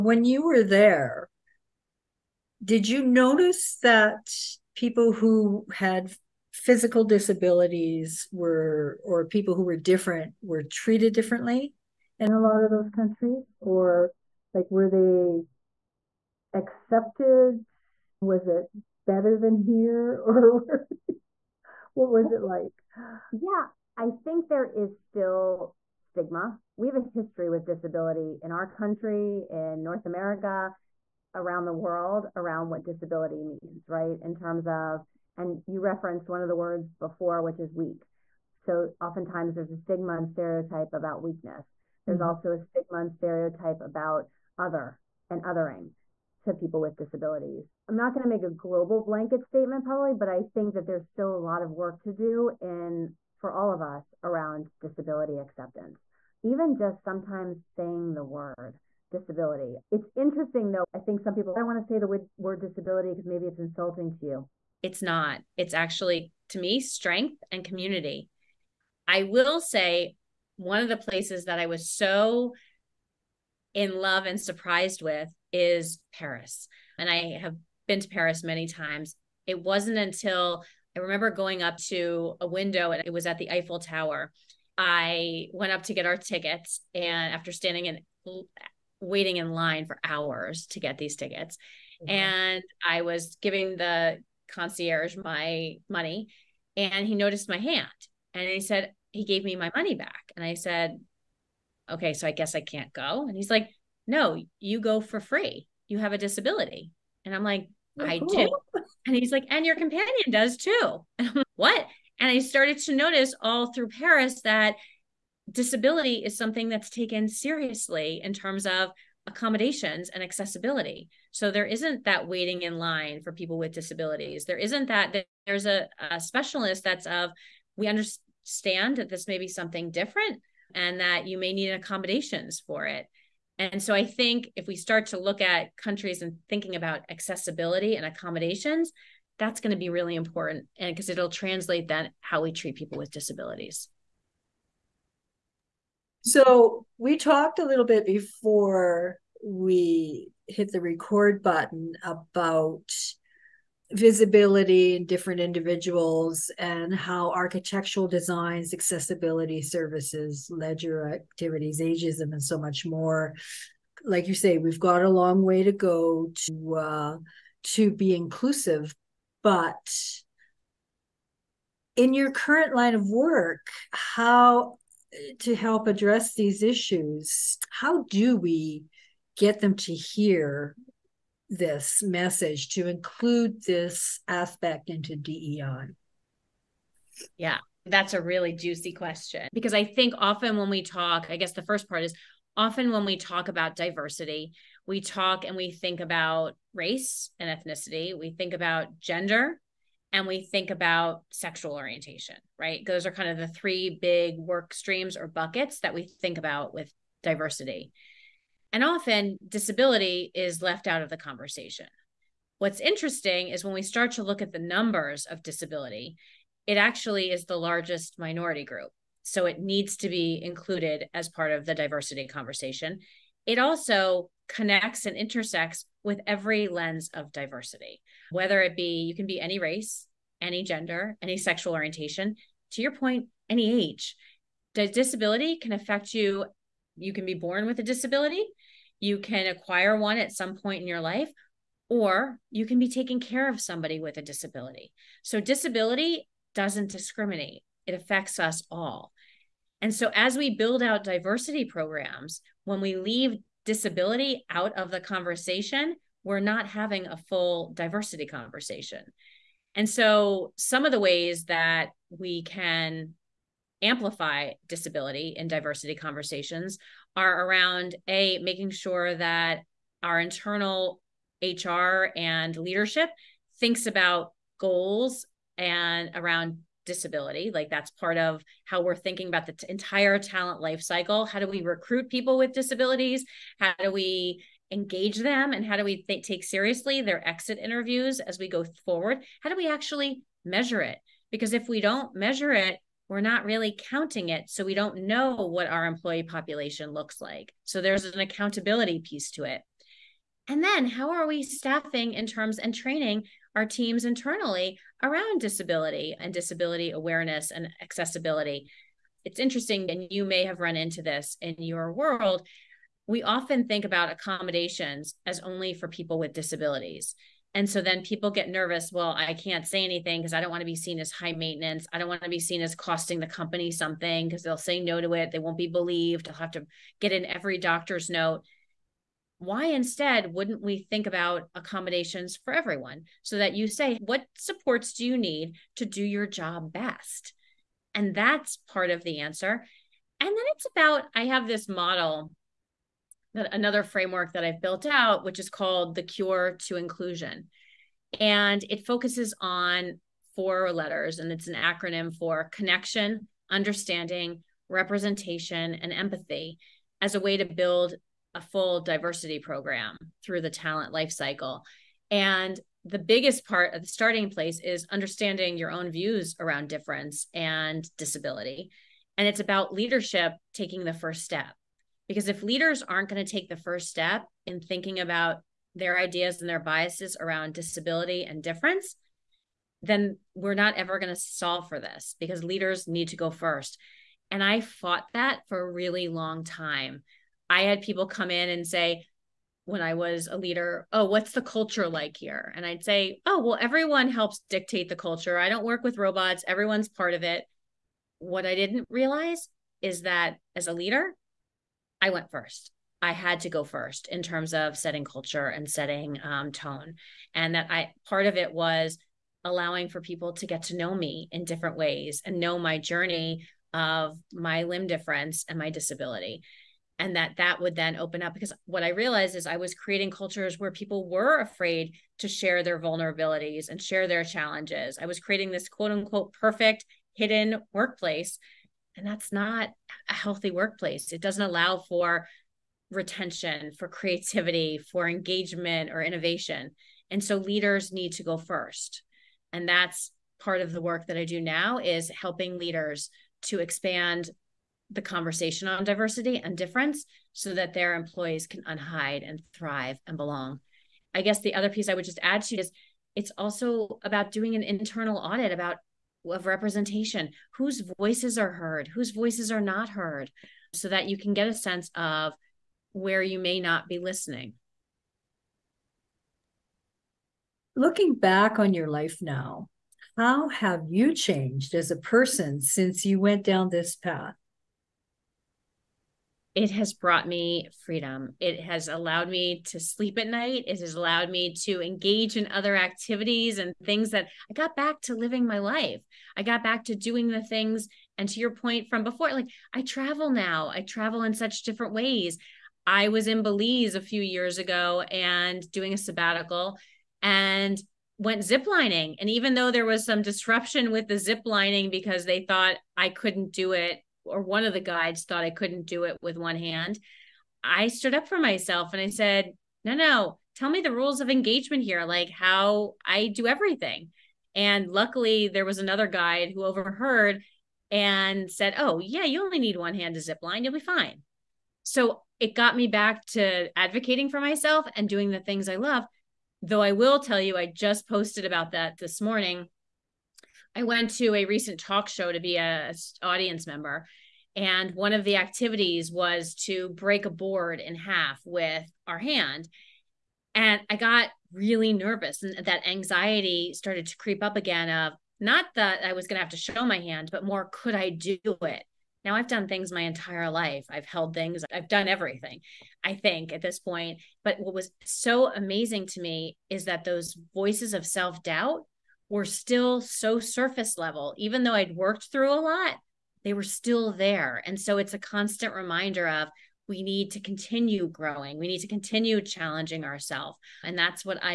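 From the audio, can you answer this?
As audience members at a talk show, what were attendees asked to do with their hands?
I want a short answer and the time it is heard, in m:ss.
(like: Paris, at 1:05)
Break a board, at 8:56.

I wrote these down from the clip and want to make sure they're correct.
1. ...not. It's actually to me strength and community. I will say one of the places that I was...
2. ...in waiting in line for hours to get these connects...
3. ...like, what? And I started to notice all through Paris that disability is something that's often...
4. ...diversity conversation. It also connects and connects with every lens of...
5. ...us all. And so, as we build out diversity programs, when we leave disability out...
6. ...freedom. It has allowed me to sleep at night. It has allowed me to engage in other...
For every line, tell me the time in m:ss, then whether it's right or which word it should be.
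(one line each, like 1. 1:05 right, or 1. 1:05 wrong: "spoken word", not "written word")
1. 1:05 right
2. 1:27 wrong: "tickets", not "connects"
3. 1:51 wrong: "taken", not "often"
4. 3:41 wrong: "intersects", not "connects"
5. 4:08 right
6. 7:57 right.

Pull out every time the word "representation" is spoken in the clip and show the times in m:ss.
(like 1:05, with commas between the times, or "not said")
5:54, 7:36.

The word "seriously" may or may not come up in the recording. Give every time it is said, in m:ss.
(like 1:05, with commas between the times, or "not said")
1:57, 4:46.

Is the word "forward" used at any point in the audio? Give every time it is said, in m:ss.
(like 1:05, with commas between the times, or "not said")
4:48.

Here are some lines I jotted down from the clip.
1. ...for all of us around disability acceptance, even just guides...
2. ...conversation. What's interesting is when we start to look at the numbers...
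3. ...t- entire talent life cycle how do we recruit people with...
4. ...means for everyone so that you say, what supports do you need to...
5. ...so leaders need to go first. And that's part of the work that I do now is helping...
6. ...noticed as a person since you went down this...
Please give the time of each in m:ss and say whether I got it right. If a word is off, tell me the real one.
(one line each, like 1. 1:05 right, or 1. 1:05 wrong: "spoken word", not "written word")
1. 0:53 wrong: "sometimes", not "guides"
2. 3:31 right
3. 4:39 right
4. 5:31 wrong: "accommodations", not "means"
5. 7:17 right
6. 7:51 wrong: "changed", not "noticed".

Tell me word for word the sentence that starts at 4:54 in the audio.
So we don't know what our employee population looks like.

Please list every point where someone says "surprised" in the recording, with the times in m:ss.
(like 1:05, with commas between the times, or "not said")
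1:14.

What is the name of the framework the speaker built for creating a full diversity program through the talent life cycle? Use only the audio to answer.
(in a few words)
Cure to Inclusion.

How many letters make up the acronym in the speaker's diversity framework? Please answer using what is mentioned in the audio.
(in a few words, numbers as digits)
4.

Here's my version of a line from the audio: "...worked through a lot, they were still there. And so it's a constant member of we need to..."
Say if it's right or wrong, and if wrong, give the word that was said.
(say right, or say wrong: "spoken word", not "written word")
wrong: "reminder", not "member".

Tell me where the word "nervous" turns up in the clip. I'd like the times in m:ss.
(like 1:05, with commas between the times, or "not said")
5:18, 9:01.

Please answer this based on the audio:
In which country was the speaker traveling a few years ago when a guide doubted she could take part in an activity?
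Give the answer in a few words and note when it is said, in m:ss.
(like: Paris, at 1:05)
Belize, at 8:13.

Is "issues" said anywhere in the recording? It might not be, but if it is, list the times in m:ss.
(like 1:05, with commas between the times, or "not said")
2:56.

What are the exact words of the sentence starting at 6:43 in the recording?
I had to go first in terms of setting culture and setting um, tone.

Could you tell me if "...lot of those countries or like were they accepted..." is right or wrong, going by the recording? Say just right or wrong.
right.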